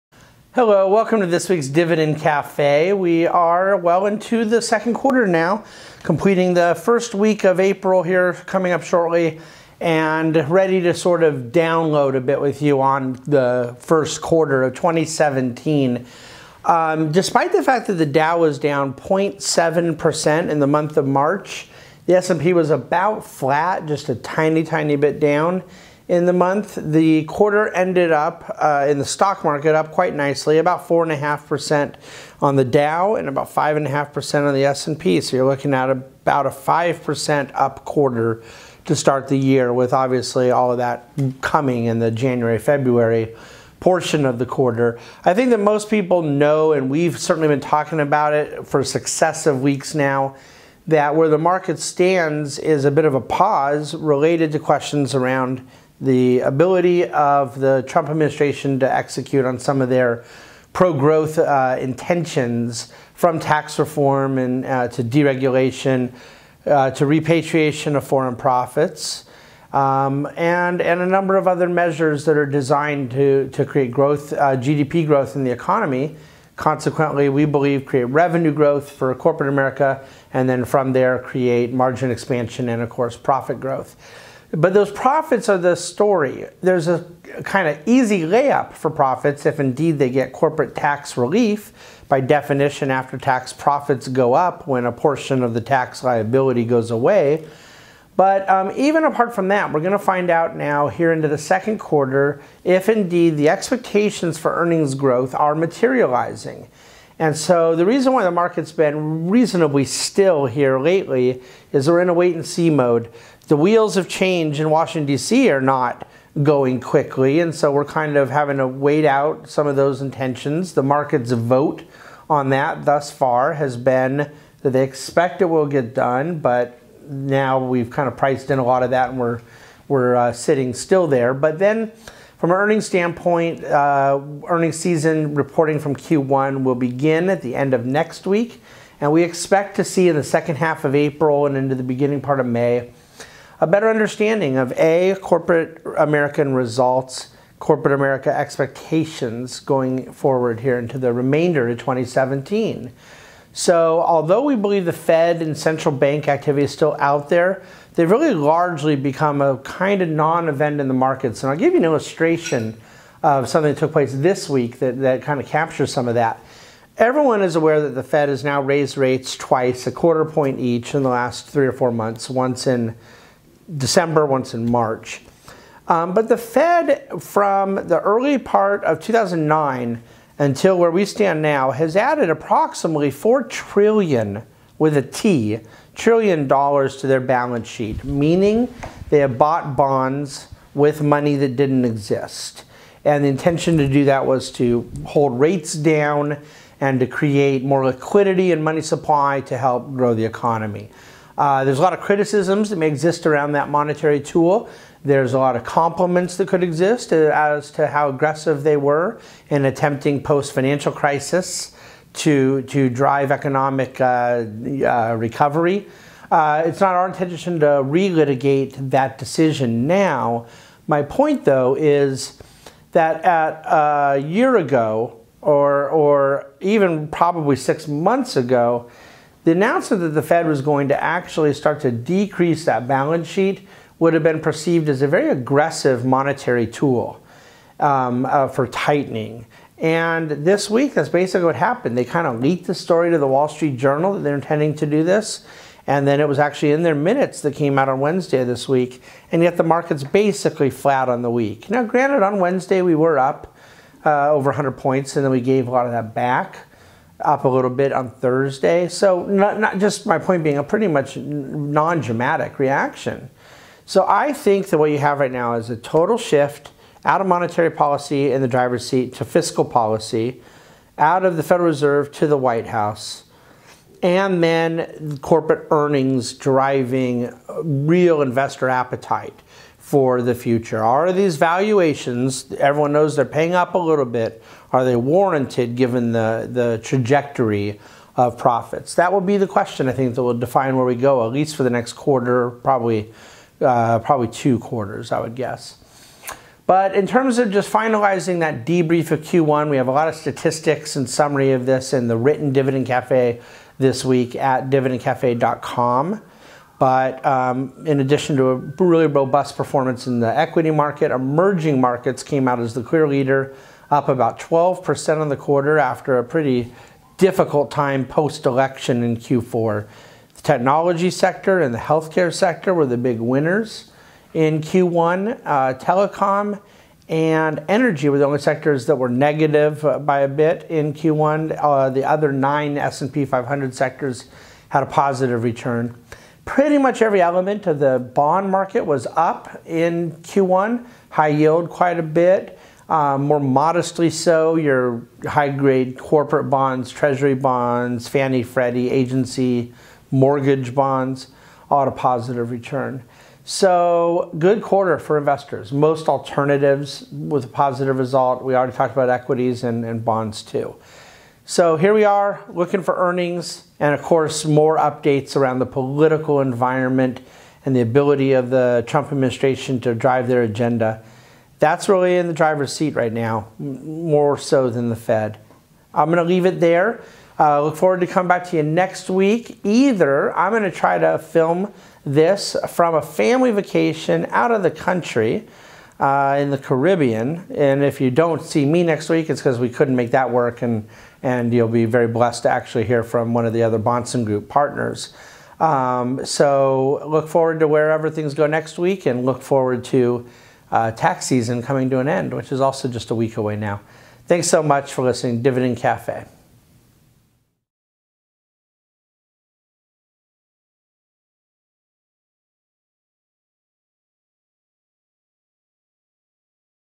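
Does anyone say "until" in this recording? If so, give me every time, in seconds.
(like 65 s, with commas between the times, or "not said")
180 s.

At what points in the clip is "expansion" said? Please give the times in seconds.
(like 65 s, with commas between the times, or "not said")
82 s.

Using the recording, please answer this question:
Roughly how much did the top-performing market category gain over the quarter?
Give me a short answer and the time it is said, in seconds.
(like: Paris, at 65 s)
12%, at 314 s.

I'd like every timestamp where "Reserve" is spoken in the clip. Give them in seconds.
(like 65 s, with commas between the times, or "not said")
271 s.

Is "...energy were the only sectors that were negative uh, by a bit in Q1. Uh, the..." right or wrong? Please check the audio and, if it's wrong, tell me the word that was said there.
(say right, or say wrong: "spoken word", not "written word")
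right.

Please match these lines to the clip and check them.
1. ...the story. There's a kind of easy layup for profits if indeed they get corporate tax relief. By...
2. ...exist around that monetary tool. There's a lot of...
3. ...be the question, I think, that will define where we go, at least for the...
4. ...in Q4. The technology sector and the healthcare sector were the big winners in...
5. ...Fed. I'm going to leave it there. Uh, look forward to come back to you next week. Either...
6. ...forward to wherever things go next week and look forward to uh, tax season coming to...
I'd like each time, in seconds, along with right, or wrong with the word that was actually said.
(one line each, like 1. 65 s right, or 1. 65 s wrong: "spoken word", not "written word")
1. 85 s right
2. 202 s right
3. 289 s right
4. 319 s right
5. 374 s right
6. 397 s right.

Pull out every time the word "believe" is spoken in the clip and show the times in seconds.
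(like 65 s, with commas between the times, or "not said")
77 s, 154 s.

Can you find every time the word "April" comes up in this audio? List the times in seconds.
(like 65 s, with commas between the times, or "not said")
7 s, 140 s.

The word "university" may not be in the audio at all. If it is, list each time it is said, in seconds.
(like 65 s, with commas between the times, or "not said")
not said.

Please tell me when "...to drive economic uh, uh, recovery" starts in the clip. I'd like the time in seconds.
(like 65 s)
212 s.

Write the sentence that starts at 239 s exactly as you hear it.
And this week, that's basically what happened.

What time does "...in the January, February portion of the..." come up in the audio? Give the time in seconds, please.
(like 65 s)
41 s.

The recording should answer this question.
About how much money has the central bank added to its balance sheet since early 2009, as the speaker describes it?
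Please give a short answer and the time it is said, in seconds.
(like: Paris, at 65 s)
$4 trillion, at 183 s.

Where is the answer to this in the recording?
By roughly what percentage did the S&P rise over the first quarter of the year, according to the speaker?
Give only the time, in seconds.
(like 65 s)
33 s.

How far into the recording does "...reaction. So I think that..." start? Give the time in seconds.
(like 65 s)
262 s.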